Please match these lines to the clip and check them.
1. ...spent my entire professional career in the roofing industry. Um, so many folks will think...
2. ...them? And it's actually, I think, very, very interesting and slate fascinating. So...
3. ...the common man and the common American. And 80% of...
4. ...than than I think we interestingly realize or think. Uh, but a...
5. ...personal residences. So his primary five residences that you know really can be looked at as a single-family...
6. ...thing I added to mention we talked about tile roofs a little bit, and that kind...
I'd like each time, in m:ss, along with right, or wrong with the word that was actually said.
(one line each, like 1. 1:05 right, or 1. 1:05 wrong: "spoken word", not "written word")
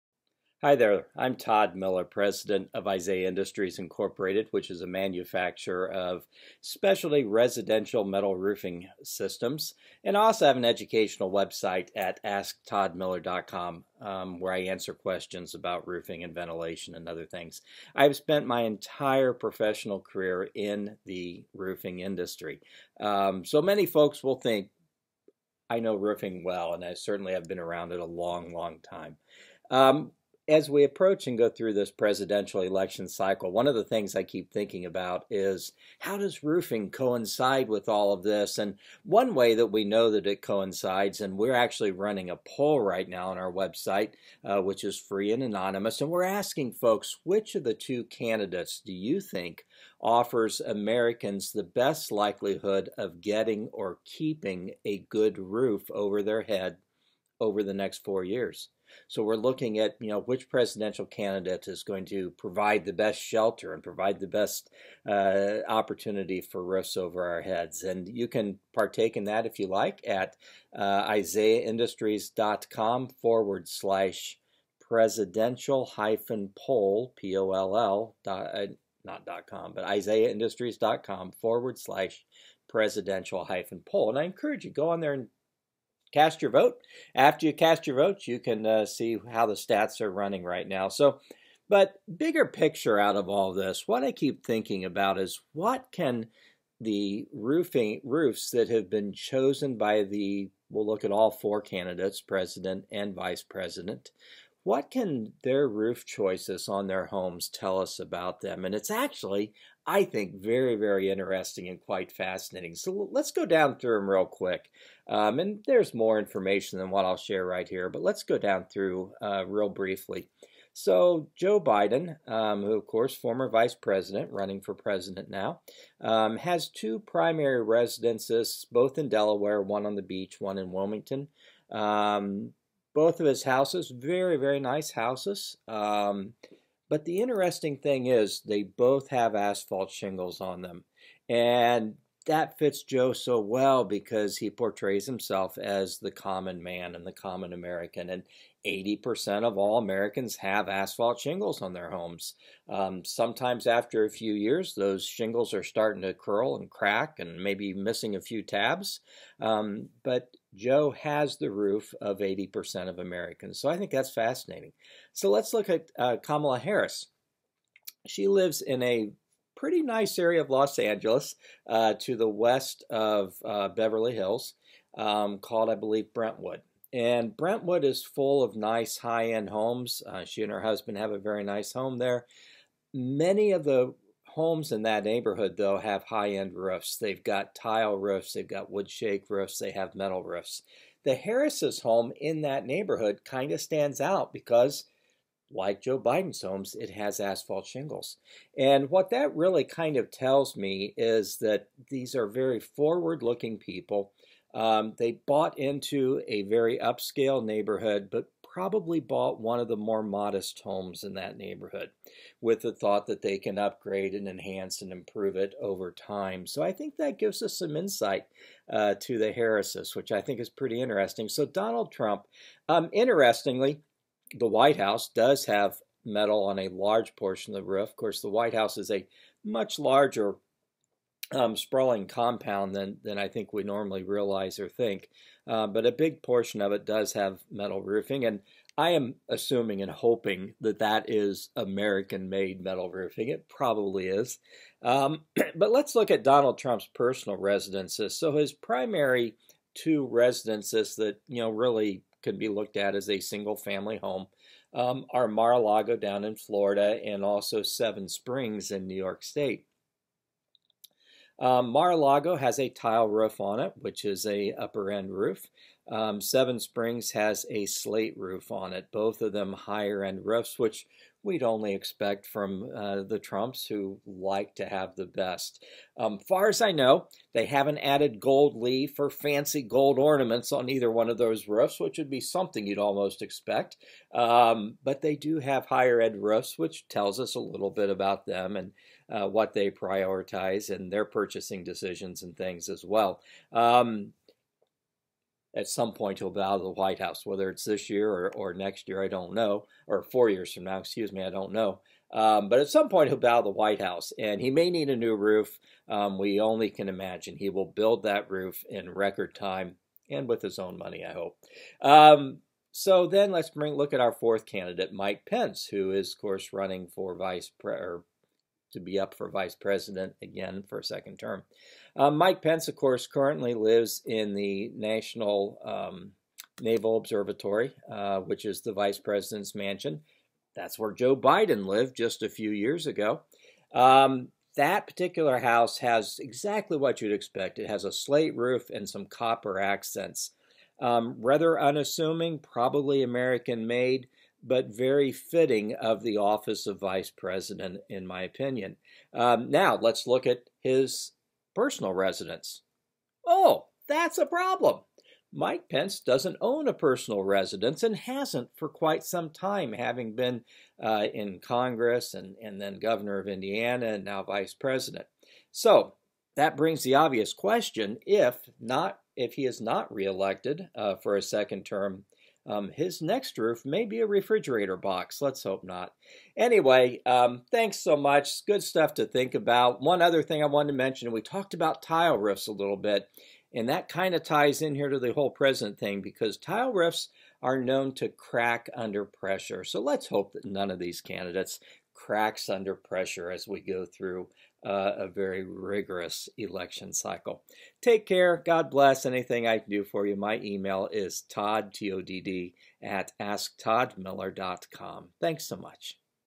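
1. 0:18 right
2. 1:48 wrong: "quite", not "slate"
3. 2:25 right
4. 3:52 wrong: "normally", not "interestingly"
5. 4:06 wrong: "two", not "five"
6. 6:20 wrong: "wanted", not "added".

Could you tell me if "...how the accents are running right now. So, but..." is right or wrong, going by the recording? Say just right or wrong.
wrong.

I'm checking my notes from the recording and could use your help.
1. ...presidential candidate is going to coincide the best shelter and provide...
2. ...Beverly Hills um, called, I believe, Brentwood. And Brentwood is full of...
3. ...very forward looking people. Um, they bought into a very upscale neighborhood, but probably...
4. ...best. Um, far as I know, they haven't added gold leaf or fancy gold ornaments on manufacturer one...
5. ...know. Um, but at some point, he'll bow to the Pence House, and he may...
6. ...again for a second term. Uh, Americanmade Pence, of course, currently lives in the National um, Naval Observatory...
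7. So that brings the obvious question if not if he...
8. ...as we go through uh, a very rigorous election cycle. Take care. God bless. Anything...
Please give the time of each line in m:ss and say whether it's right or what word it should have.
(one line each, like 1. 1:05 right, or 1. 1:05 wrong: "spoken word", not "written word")
1. 1:00 wrong: "provide", not "coincide"
2. 2:53 right
3. 3:22 right
4. 4:35 wrong: "either", not "manufacturer"
5. 5:01 wrong: "White", not "Pence"
6. 5:20 wrong: "Mike", not "Americanmade"
7. 6:05 right
8. 6:33 right.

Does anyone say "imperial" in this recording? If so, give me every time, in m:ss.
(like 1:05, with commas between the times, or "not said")
not said.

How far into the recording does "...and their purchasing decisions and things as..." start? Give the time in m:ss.
4:50.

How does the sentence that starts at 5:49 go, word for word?
Um, now, let's look at his personal residence.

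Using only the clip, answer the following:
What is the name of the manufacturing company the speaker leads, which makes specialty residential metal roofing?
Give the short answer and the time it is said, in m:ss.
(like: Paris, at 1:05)
Isaiah Industries Incorporated, at 0:02.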